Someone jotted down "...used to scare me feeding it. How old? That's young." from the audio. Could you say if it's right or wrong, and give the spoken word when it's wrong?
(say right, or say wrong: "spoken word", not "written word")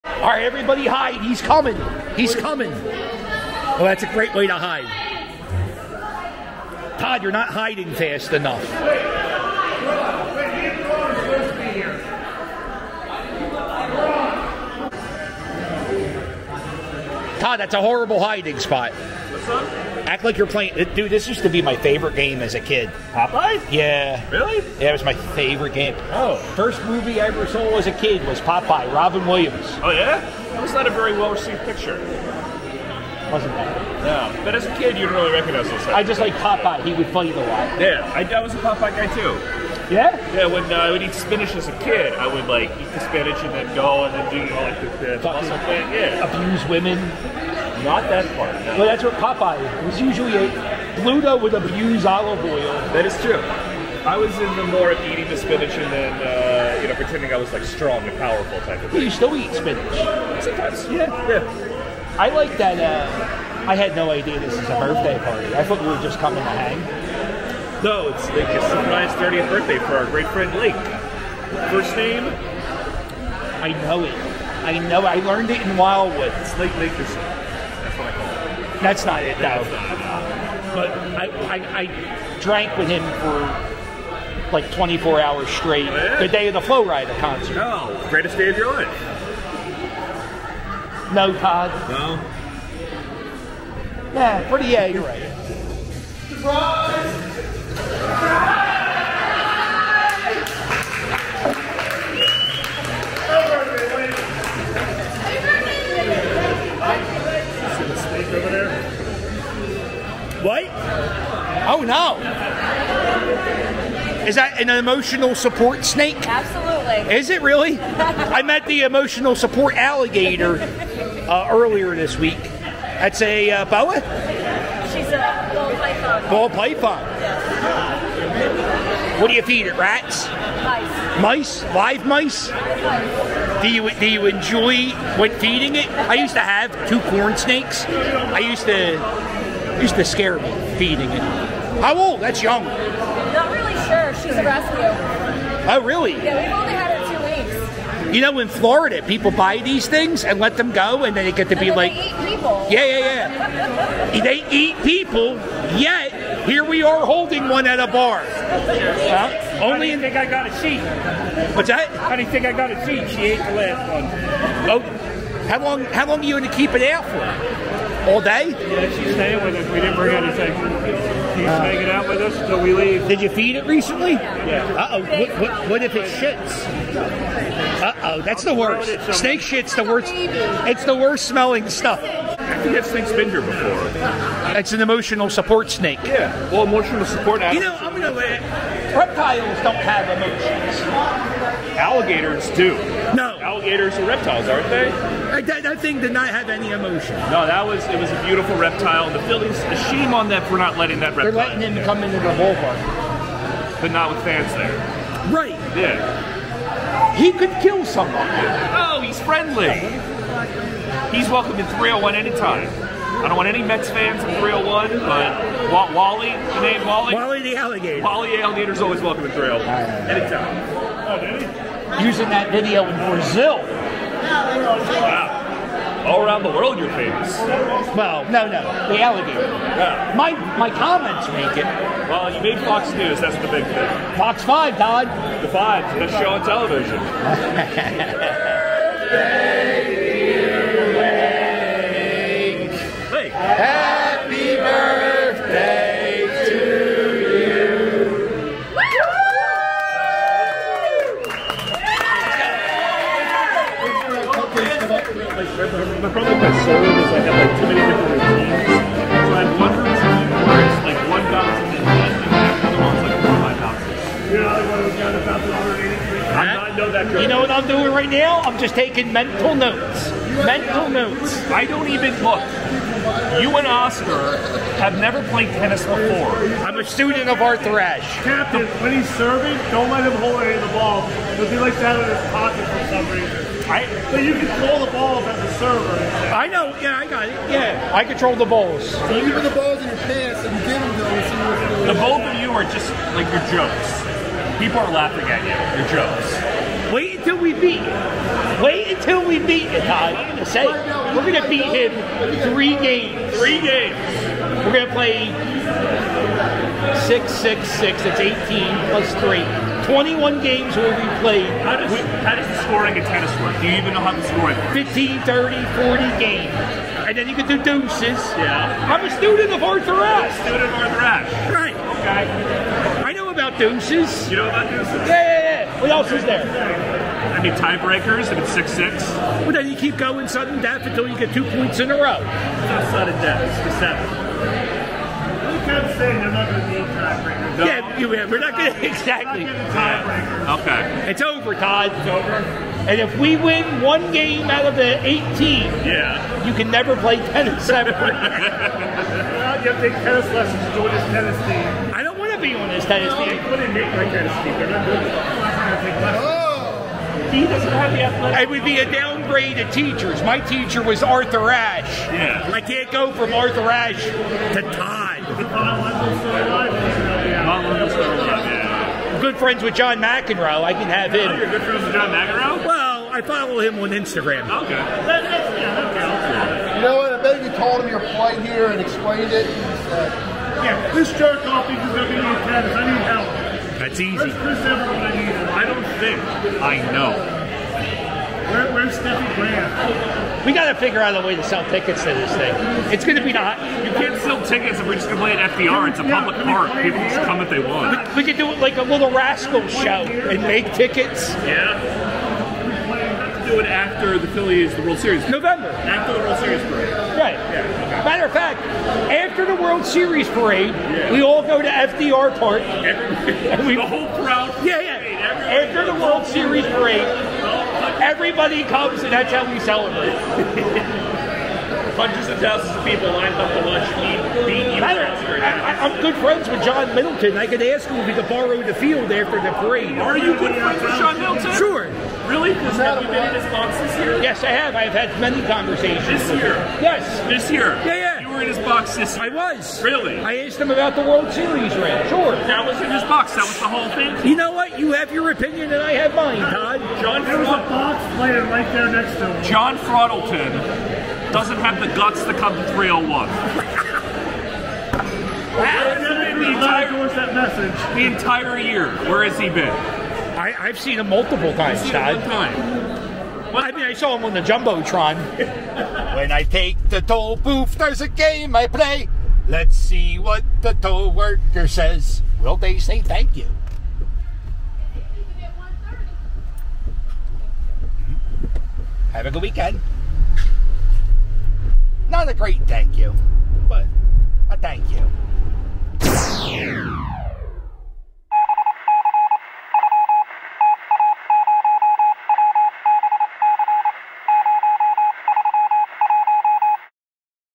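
right.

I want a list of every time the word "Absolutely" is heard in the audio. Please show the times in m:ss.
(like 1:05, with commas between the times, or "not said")
1:56.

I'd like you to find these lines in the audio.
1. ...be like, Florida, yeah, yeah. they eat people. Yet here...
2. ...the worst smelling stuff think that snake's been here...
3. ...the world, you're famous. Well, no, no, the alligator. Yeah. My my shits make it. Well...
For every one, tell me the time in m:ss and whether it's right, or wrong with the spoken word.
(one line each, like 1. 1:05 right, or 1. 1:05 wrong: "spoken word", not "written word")
1. 2:31 wrong: "Yeah", not "Florida"
2. 3:00 right
3. 3:46 wrong: "comments", not "shits".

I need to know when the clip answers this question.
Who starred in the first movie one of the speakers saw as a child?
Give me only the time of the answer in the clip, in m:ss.
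0:28.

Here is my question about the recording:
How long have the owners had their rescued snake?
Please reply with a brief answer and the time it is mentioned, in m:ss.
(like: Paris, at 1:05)
two weeks, at 2:28.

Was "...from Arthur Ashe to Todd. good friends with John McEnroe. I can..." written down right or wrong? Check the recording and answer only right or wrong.
right.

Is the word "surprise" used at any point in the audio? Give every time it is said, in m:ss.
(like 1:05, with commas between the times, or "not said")
1:08, 1:36.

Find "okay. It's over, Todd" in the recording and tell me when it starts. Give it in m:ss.
5:40.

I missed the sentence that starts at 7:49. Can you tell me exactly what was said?
Let's see what the toll worker says.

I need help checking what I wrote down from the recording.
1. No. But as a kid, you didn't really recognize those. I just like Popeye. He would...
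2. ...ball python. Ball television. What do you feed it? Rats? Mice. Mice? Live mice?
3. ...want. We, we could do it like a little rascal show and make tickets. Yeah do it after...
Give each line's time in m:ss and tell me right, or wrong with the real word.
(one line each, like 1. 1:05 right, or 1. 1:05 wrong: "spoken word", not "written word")
1. 0:34 right
2. 2:05 wrong: "python", not "television"
3. 6:37 right.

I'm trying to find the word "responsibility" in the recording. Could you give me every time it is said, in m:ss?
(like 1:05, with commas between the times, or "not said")
not said.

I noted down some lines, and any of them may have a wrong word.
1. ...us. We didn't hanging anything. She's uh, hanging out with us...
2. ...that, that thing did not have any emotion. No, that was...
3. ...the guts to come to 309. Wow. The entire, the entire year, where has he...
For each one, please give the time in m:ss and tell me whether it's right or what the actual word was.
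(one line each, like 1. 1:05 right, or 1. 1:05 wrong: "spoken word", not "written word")
1. 2:49 wrong: "bring", not "hanging"
2. 3:15 right
3. 7:31 wrong: "301", not "309".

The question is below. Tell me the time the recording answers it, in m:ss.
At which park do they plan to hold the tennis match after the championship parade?
6:51.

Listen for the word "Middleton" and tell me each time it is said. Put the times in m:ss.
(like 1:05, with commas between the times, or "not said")
7:06, 7:11.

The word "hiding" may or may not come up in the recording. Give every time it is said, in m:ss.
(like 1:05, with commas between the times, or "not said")
0:07, 0:18.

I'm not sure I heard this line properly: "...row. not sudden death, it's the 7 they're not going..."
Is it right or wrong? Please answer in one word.
right.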